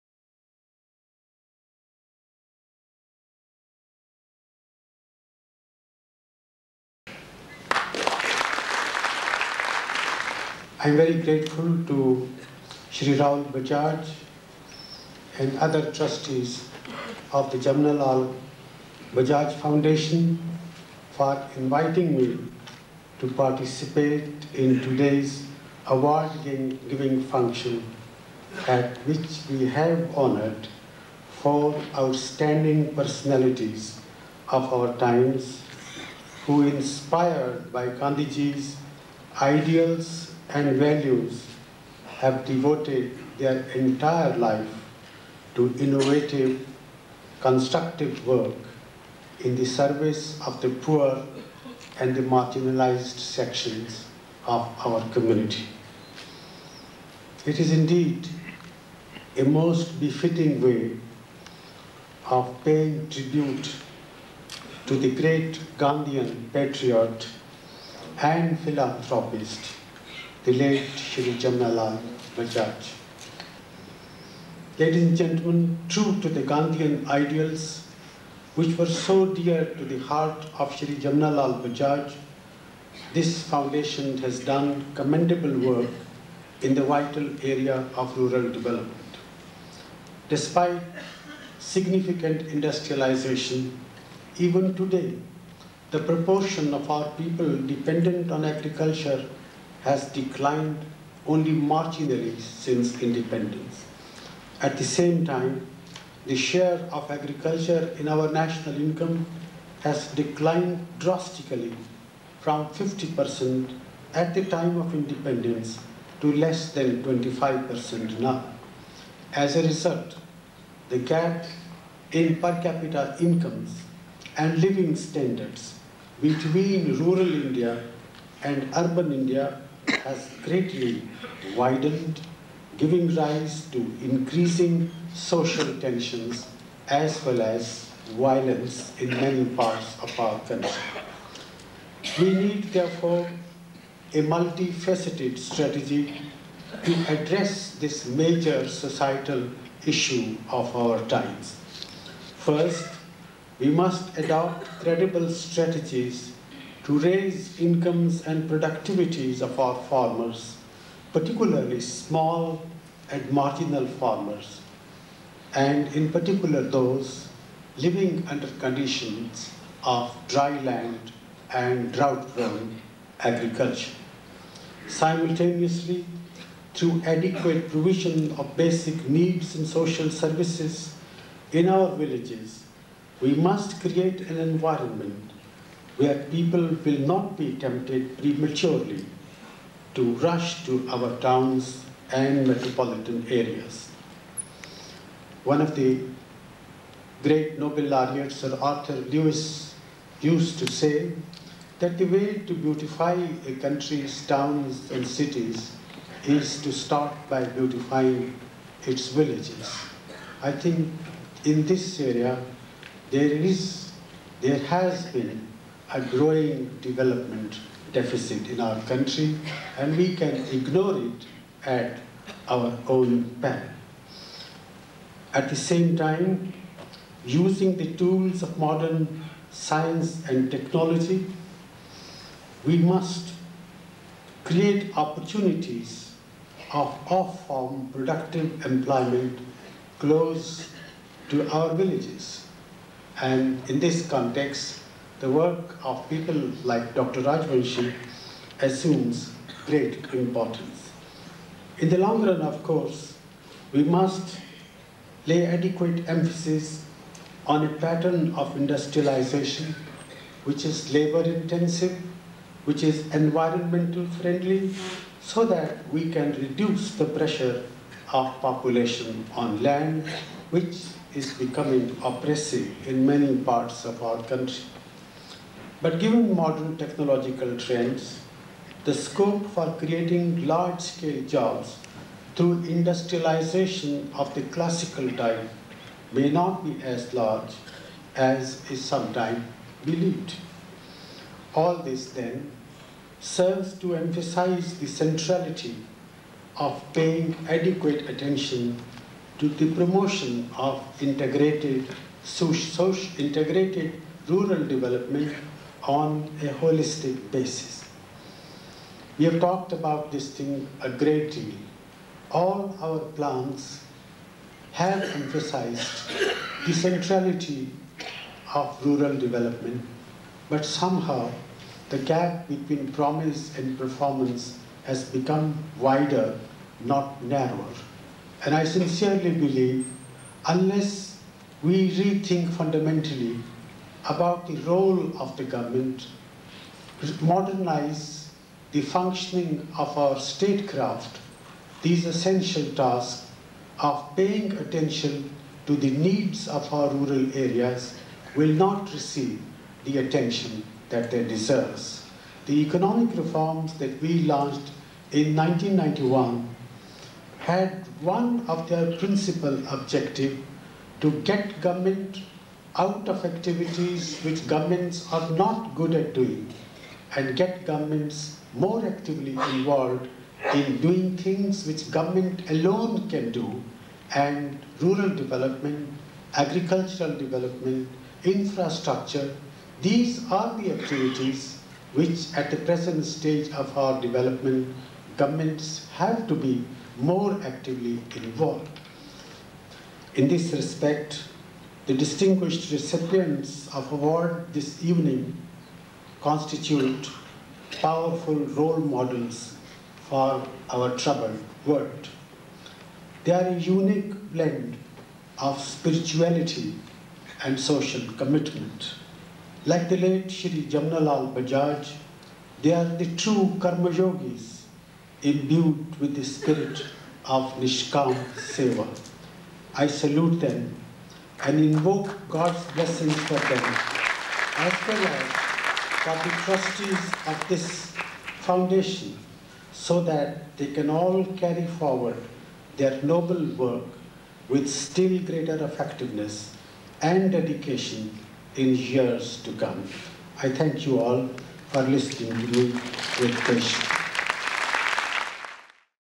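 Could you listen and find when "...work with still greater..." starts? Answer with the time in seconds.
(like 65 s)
433 s.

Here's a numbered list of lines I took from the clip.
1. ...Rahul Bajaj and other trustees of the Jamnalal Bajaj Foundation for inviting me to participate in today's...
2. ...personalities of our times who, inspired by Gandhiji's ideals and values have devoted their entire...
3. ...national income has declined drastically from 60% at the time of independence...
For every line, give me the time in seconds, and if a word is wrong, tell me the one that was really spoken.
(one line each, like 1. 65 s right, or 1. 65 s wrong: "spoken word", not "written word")
1. 13 s right
2. 32 s right
3. 108 s wrong: "50", not "60".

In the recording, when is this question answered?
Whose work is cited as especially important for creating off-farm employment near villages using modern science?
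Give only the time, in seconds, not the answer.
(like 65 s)
246 s.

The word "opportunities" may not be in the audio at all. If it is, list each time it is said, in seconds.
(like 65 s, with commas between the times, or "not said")
234 s.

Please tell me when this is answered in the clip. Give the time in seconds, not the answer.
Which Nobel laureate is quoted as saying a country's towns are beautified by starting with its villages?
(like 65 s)
198 s.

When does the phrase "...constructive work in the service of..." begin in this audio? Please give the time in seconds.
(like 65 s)
47 s.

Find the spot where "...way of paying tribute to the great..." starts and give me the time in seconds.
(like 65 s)
60 s.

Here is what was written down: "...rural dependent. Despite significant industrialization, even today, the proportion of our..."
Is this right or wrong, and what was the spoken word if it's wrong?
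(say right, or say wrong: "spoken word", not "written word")
wrong: "development", not "dependent".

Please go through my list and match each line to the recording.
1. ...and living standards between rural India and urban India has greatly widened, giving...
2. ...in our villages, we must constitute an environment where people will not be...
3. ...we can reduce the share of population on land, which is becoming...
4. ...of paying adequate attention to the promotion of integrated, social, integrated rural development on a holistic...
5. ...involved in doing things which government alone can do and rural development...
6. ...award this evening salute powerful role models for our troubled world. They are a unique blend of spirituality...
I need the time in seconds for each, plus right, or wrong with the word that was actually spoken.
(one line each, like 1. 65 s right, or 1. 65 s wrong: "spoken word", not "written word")
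1. 124 s right
2. 181 s wrong: "create", not "constitute"
3. 265 s wrong: "pressure", not "share"
4. 296 s right
5. 369 s right
6. 393 s wrong: "constitute", not "salute".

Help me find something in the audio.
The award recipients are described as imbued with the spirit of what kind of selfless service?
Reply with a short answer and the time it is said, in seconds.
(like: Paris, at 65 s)
Nishkam Seva, at 417 s.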